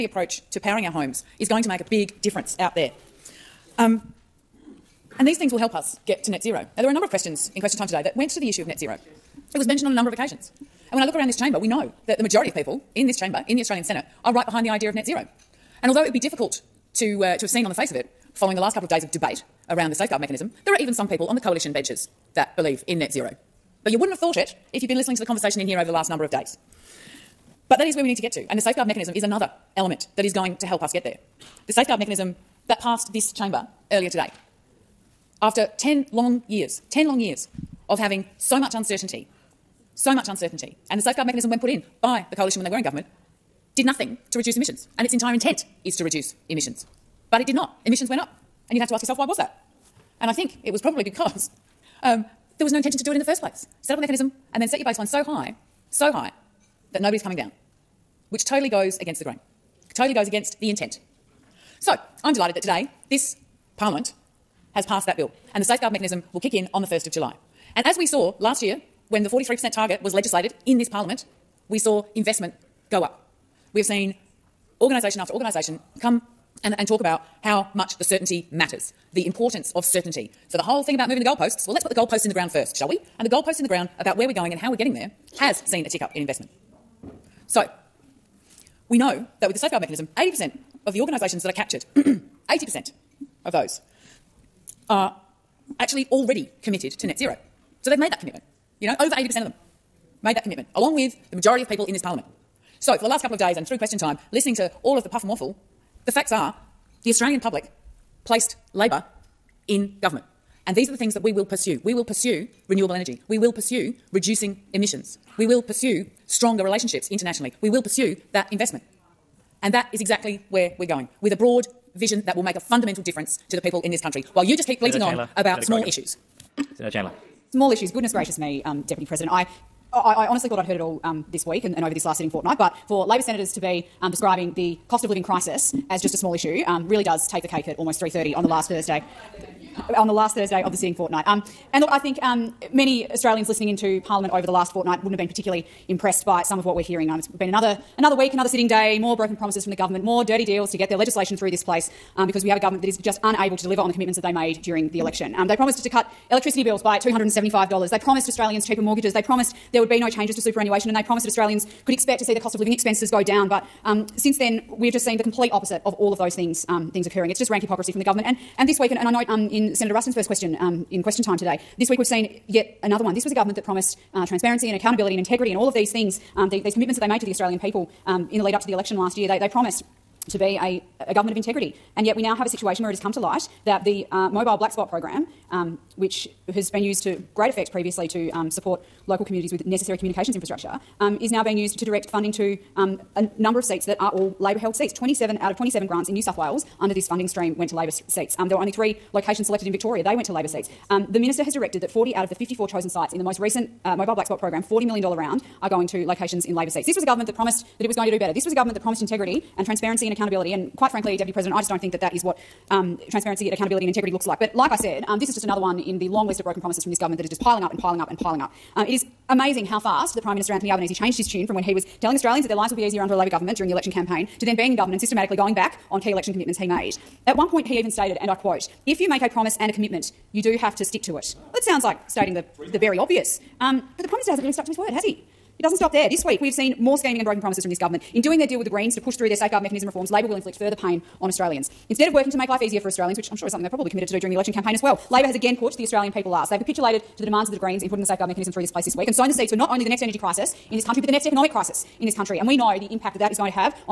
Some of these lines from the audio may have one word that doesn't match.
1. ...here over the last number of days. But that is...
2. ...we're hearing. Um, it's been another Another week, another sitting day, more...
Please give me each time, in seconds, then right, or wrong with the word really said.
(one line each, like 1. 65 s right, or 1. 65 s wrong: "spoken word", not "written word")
1. 25 s right
2. 146 s right.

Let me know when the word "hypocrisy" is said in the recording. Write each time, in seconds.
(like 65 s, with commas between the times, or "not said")
167 s.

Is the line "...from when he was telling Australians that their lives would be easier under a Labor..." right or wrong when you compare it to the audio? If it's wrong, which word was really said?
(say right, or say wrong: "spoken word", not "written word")
right.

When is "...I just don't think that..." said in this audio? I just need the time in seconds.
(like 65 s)
211 s.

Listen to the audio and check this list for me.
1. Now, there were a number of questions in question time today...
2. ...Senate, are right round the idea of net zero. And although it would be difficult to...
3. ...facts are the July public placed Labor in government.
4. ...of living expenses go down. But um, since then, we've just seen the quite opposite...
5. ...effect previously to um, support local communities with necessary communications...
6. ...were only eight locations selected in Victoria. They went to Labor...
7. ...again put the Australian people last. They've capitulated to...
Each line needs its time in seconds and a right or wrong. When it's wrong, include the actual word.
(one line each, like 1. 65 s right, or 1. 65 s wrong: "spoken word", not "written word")
1. 6 s right
2. 13 s wrong: "behind", not "round"
3. 106 s wrong: "Australian", not "July"
4. 162 s wrong: "complete", not "quite"
5. 187 s right
6. 198 s wrong: "three", not "eight"
7. 245 s right.